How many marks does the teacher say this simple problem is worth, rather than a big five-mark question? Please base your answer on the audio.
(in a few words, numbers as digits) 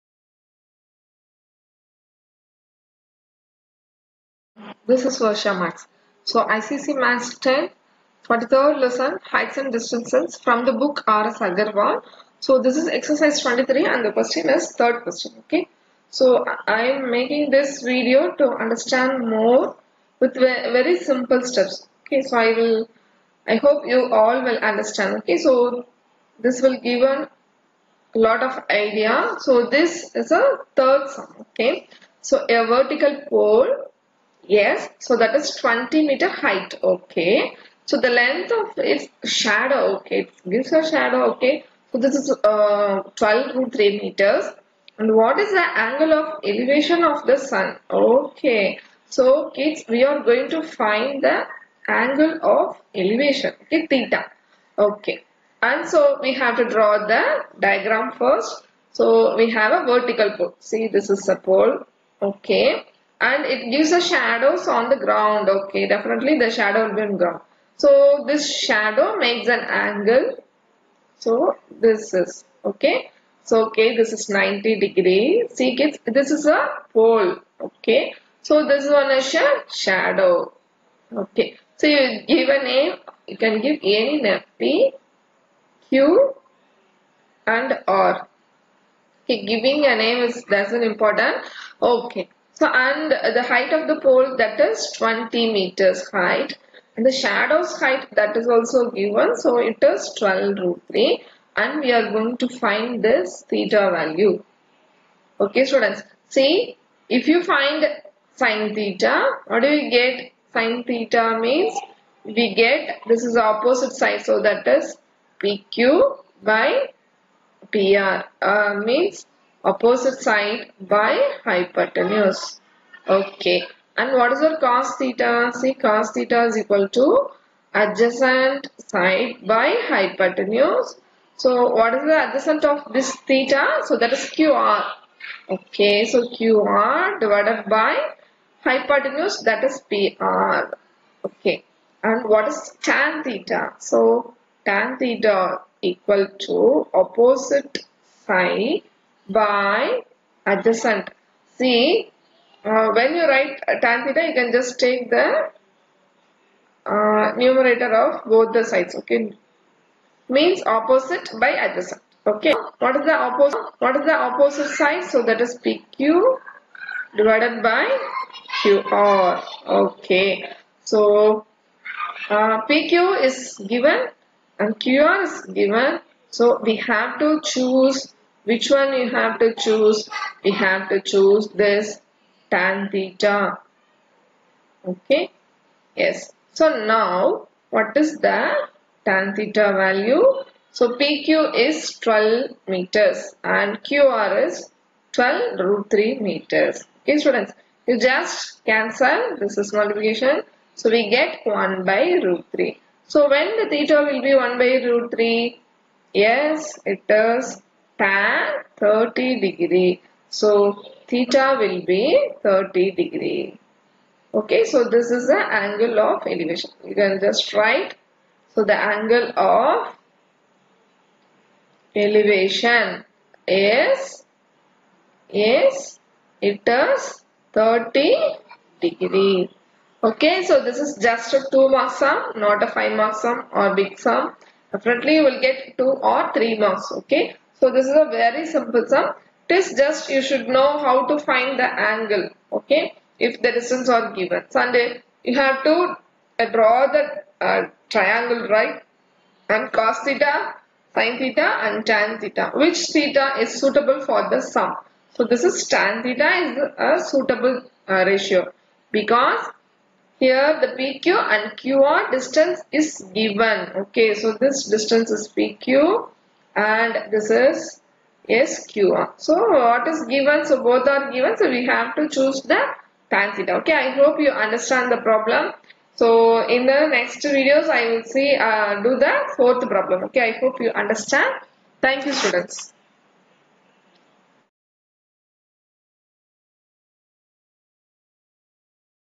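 2.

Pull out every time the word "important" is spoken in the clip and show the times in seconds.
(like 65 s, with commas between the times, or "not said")
90 s.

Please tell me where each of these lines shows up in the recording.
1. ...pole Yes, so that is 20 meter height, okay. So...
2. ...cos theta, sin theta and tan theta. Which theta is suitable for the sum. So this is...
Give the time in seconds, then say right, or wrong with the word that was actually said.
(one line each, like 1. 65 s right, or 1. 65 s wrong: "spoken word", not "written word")
1. 33 s right
2. 249 s right.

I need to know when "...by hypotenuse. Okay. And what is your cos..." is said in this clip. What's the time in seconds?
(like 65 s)
120 s.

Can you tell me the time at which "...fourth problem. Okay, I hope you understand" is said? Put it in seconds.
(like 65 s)
279 s.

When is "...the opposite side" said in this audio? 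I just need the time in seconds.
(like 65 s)
164 s.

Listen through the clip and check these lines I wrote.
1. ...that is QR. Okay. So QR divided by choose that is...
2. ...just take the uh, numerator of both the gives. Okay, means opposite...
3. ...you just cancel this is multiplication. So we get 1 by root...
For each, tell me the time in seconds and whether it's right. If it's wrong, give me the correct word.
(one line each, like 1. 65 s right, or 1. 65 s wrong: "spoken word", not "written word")
1. 133 s wrong: "hypotenuse", not "choose"
2. 154 s wrong: "sides", not "gives"
3. 197 s right.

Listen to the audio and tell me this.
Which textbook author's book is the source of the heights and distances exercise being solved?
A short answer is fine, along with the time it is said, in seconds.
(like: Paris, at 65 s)
R.S. Agarwal, at 11 s.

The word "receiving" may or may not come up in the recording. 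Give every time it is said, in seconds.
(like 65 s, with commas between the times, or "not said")
not said.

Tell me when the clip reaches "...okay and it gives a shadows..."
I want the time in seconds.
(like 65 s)
62 s.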